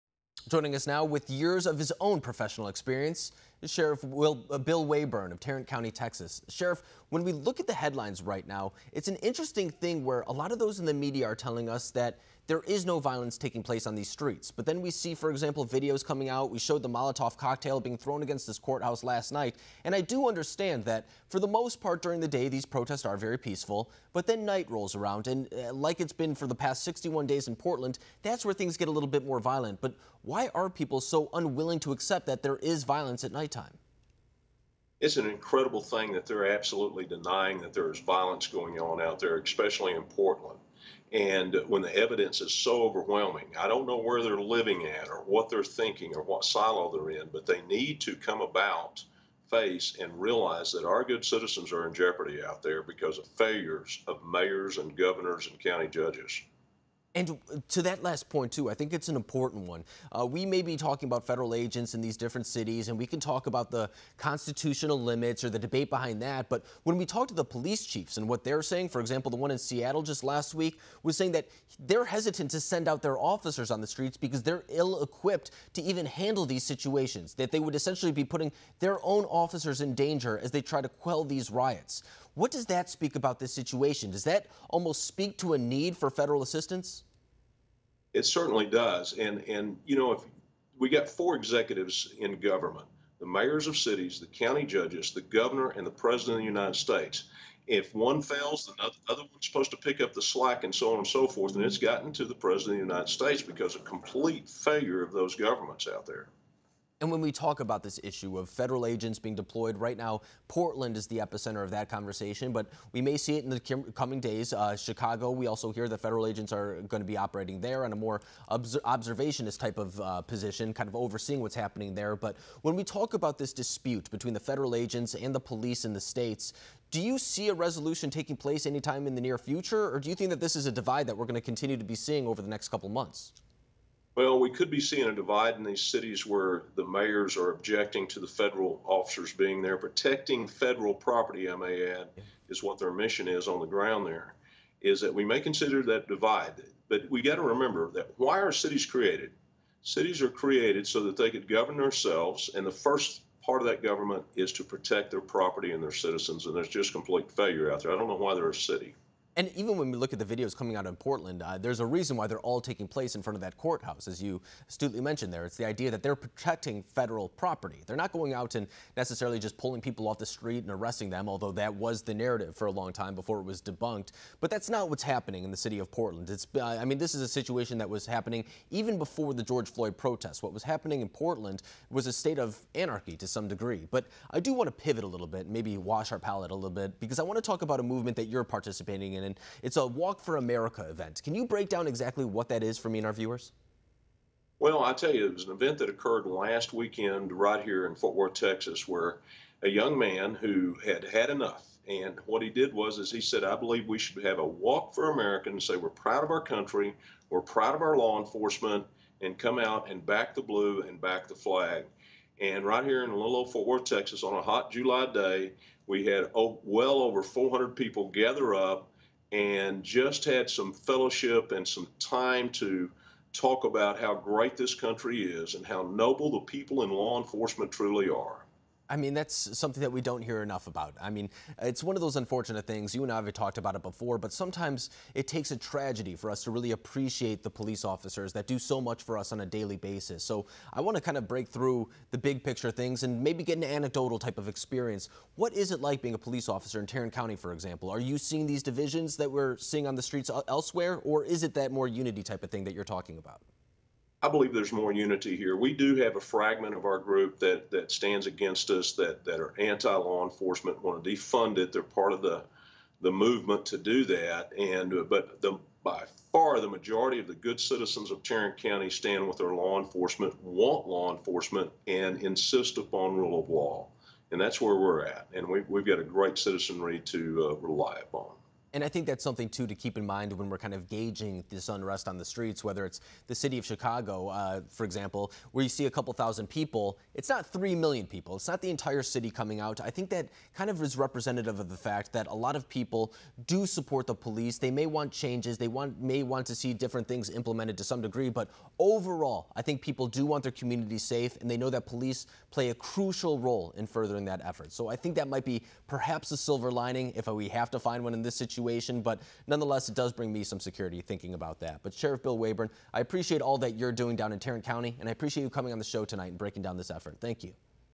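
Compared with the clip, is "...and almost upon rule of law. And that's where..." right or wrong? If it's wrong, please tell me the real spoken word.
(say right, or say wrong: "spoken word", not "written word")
wrong: "insist", not "almost".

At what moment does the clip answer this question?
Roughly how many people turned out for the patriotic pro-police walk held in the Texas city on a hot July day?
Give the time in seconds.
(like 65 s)
216 s.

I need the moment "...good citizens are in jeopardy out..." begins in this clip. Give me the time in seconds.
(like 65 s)
51 s.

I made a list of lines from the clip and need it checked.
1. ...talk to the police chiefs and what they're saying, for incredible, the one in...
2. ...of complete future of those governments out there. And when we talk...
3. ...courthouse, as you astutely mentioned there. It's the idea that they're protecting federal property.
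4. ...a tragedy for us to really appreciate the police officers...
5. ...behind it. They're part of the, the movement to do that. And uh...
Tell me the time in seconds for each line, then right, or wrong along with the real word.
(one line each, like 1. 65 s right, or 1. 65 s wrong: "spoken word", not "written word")
1. 67 s wrong: "example", not "incredible"
2. 103 s wrong: "failure", not "future"
3. 163 s right
4. 235 s right
5. 261 s wrong: "defund", not "behind".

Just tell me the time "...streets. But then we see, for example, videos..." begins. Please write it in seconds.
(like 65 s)
14 s.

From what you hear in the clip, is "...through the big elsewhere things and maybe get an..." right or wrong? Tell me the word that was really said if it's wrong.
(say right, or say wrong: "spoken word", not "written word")
wrong: "picture", not "elsewhere".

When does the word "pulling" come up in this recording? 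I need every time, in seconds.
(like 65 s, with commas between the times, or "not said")
169 s.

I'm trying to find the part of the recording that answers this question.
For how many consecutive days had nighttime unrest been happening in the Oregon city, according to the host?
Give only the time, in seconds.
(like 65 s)
26 s.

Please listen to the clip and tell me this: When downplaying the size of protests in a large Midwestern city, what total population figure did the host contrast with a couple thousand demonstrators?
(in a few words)
3 million.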